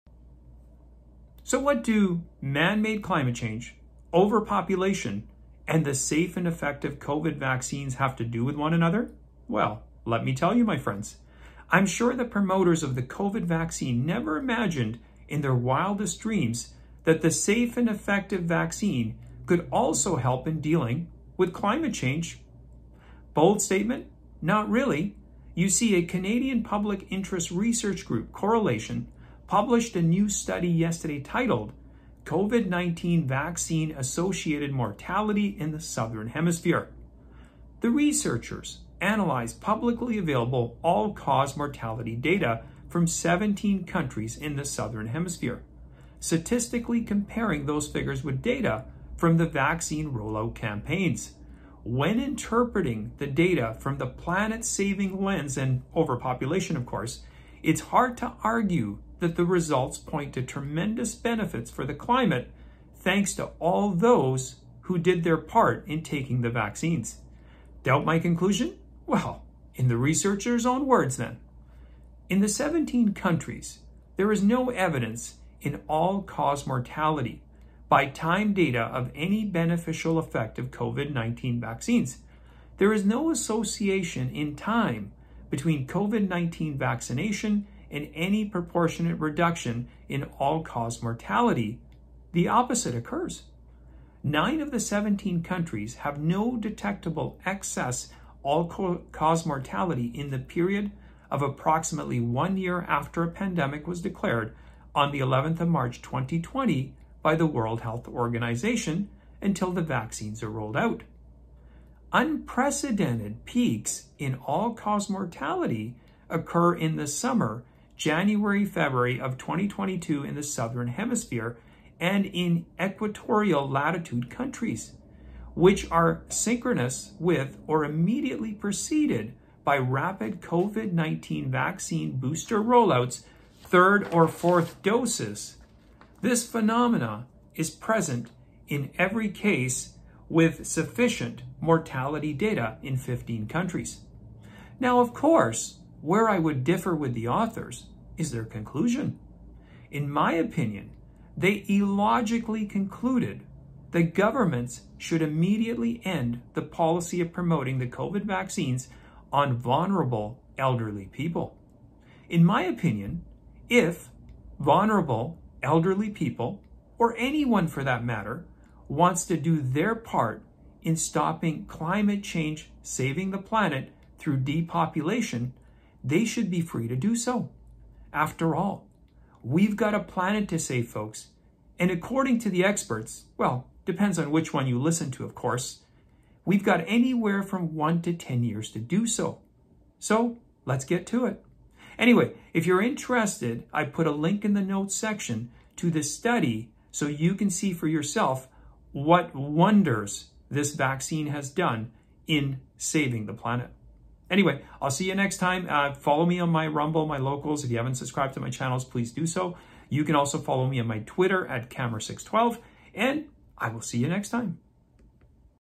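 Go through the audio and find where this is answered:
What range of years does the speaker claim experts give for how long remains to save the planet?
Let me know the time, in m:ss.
3:07.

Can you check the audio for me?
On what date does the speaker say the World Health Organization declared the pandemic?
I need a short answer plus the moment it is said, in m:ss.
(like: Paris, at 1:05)
11 March 2020, at 1:45.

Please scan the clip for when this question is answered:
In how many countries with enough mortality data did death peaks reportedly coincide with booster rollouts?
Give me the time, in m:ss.
2:22.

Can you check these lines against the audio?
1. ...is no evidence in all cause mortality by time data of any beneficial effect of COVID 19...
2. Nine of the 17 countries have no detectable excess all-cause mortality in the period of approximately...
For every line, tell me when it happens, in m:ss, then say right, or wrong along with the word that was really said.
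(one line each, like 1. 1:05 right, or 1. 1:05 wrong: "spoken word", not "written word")
1. 1:14 right
2. 1:34 right.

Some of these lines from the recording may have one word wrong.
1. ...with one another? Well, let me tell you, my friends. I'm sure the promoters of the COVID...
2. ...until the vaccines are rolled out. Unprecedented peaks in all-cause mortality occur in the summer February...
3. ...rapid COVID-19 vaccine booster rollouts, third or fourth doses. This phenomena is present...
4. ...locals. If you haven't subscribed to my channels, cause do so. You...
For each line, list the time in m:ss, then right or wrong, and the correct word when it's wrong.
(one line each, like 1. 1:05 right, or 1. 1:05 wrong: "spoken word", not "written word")
1. 0:08 right
2. 1:49 wrong: "January", not "February"
3. 2:09 right
4. 3:27 wrong: "please", not "cause".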